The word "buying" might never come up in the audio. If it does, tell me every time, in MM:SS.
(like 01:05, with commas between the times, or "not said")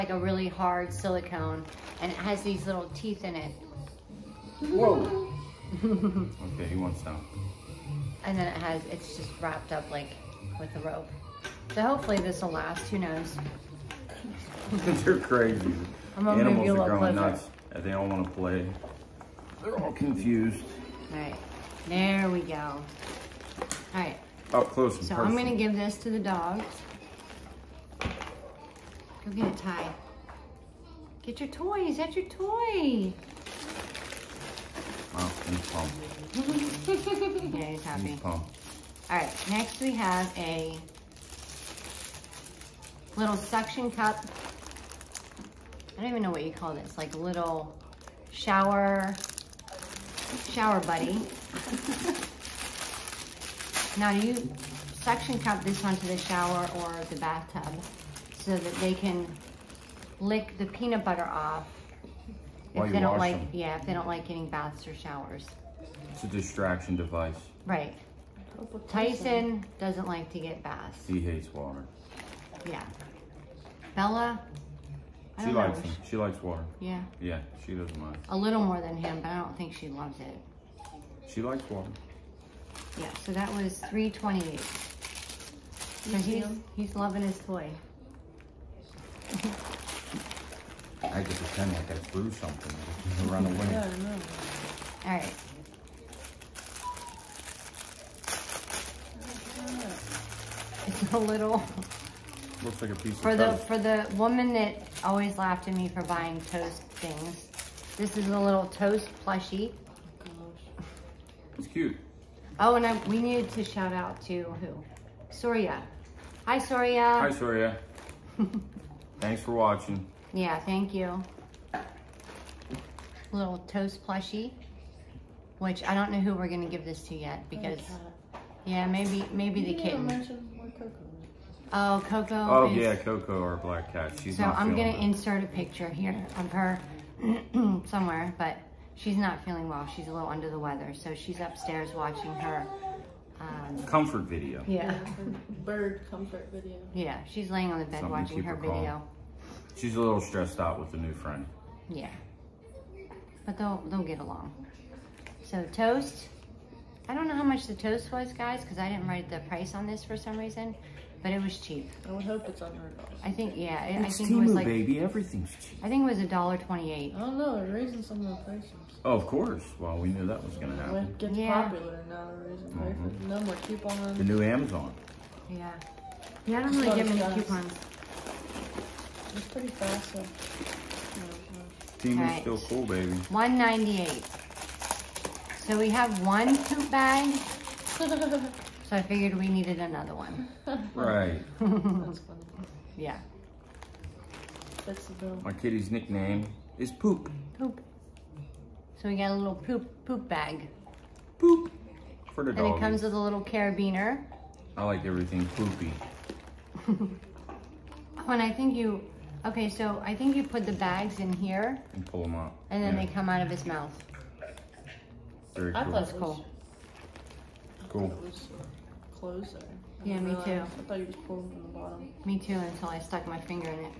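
01:46.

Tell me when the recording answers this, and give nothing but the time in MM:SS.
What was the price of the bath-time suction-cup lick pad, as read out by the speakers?
01:23.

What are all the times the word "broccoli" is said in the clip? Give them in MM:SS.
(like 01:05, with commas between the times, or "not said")
not said.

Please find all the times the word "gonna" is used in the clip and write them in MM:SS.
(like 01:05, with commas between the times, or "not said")
00:25, 00:29, 02:06, 02:14.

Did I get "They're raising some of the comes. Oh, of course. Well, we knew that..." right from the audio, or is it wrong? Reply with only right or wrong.
wrong.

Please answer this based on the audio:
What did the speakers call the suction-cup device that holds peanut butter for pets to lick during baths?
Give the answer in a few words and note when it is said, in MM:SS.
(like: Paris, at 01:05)
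shower buddy, at 00:50.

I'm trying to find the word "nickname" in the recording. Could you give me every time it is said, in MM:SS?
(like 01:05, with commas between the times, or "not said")
03:15.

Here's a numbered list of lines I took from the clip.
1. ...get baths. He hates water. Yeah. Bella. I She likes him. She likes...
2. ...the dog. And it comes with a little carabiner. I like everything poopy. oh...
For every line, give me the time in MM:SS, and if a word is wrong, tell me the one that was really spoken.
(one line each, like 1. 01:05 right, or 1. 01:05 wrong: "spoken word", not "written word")
1. 01:10 right
2. 03:22 right.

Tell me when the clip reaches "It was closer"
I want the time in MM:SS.
03:38.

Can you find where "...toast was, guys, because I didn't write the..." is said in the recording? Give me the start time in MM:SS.
02:37.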